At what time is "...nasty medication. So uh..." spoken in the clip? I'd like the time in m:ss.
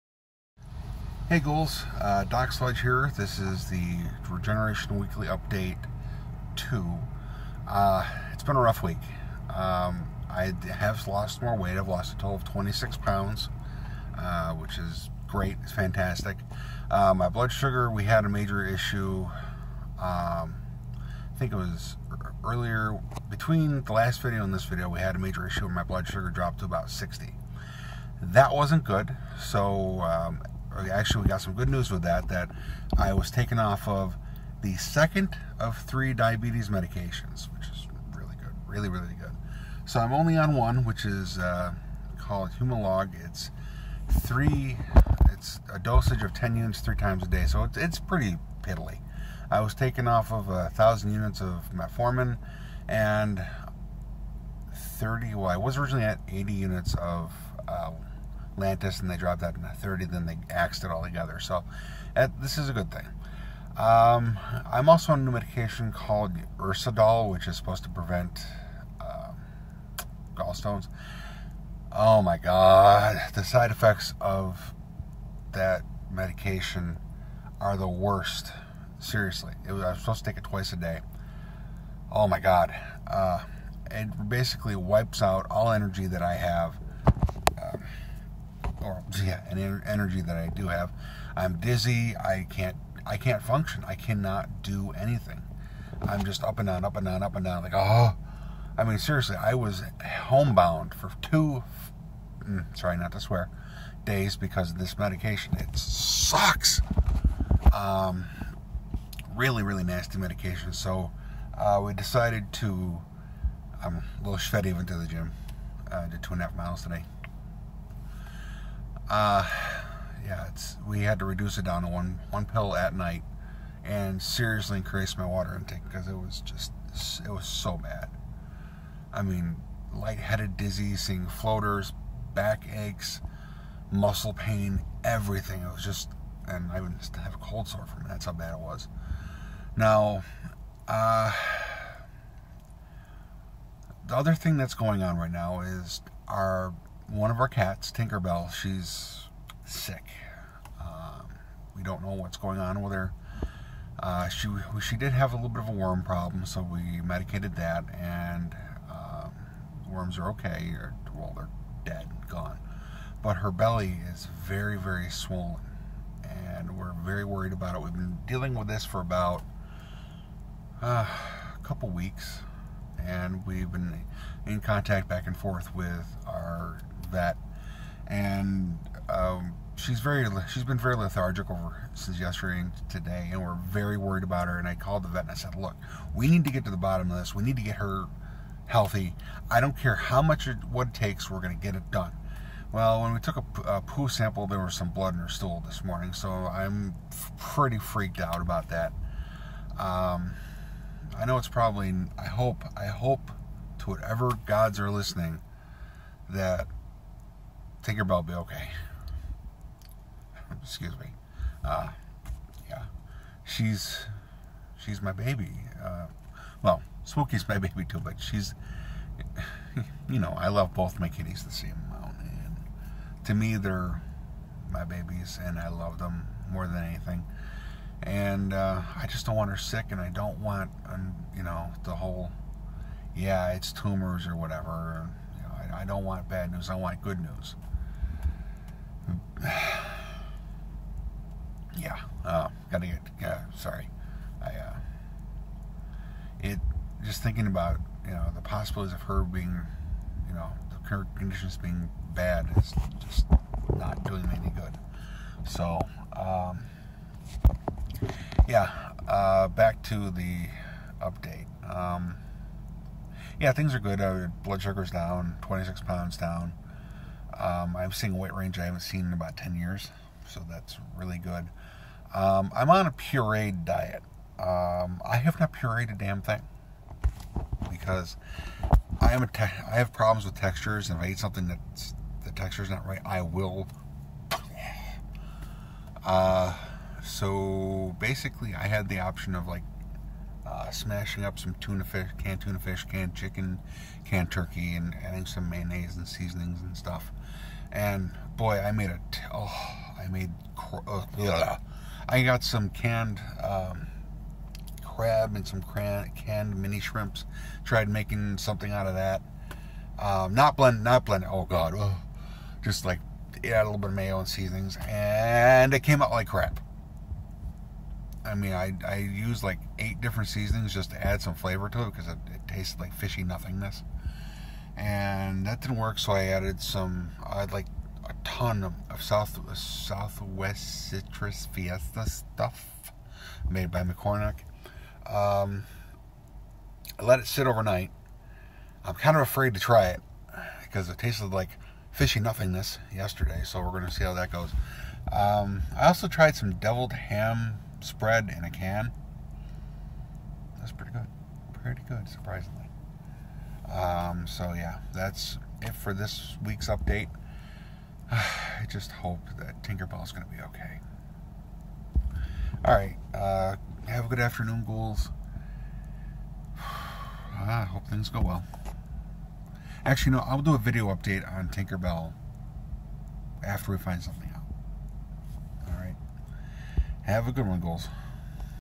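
1:49.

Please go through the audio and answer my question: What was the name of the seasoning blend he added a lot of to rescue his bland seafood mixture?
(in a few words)
Southwest Citrus Fiesta.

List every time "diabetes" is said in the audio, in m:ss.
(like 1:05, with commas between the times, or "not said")
0:36.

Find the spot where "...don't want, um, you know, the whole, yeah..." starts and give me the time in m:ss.
3:50.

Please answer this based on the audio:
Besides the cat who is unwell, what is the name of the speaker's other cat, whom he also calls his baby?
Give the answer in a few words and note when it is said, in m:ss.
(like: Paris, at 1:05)
Spooky, at 3:37.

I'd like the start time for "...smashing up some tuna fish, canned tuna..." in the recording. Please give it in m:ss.
4:50.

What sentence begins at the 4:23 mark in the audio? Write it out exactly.
Uh, blood sugar's down, 26 pounds down.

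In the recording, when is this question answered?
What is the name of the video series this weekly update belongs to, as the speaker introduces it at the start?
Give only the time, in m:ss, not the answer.
0:04.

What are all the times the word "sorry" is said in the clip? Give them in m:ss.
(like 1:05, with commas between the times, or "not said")
1:42, 4:03.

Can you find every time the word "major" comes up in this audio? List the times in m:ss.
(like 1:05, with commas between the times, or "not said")
0:18, 0:25.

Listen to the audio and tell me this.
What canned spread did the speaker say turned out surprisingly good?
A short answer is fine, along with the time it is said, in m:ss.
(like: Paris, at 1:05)
Deviled ham spread, at 5:46.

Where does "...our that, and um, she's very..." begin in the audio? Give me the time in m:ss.
2:56.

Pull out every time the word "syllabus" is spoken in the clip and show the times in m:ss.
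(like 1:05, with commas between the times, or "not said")
not said.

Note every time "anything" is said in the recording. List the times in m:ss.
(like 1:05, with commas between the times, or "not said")
1:34, 3:46.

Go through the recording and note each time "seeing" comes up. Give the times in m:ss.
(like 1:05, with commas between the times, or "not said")
2:10, 4:27.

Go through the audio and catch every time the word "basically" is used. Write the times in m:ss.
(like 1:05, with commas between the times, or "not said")
1:24, 4:47.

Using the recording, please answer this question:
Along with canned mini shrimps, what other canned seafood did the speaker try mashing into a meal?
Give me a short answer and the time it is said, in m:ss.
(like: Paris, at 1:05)
Crab, at 5:04.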